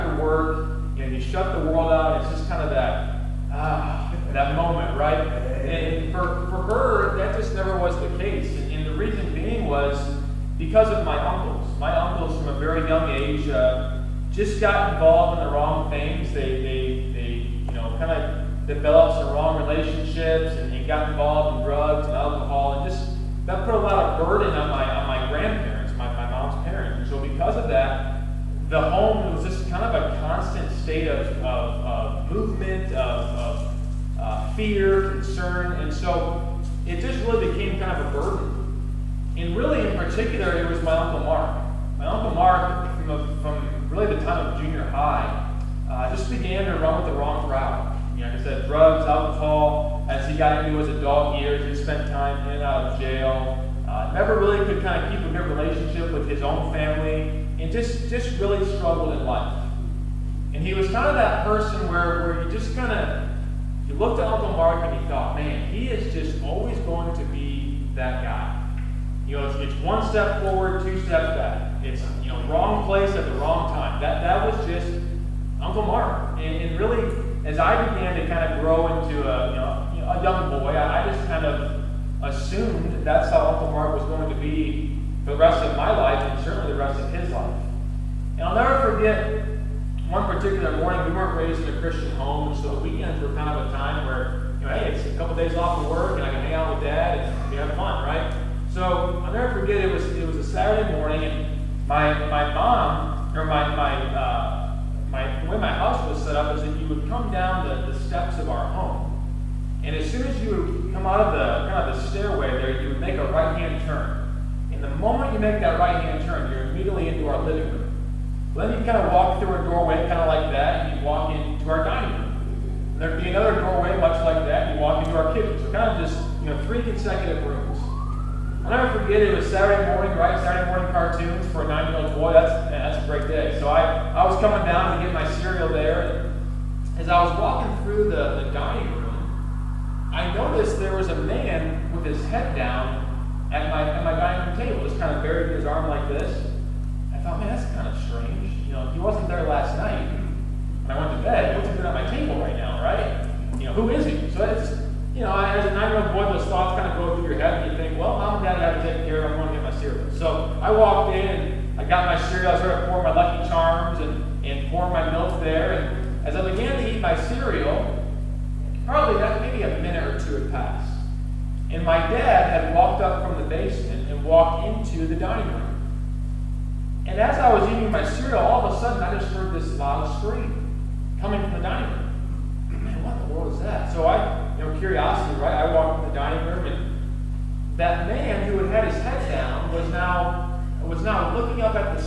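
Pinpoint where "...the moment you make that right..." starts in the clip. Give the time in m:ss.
1:54.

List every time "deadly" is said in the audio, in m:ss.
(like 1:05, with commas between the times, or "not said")
not said.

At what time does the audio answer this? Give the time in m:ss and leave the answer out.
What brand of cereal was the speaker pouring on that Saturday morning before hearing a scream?
2:43.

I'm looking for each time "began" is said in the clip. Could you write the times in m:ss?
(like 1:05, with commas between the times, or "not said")
0:46, 1:17, 2:46.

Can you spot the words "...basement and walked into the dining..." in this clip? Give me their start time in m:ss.
2:53.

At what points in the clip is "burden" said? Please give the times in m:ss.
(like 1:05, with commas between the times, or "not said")
0:24, 0:38.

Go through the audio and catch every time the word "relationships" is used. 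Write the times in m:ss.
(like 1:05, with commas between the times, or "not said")
0:19, 0:55.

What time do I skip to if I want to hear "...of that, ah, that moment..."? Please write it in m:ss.
0:02.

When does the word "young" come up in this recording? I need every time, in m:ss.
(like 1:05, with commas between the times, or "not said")
0:12, 1:20.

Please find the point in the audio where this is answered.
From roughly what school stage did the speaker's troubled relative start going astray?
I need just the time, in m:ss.
0:44.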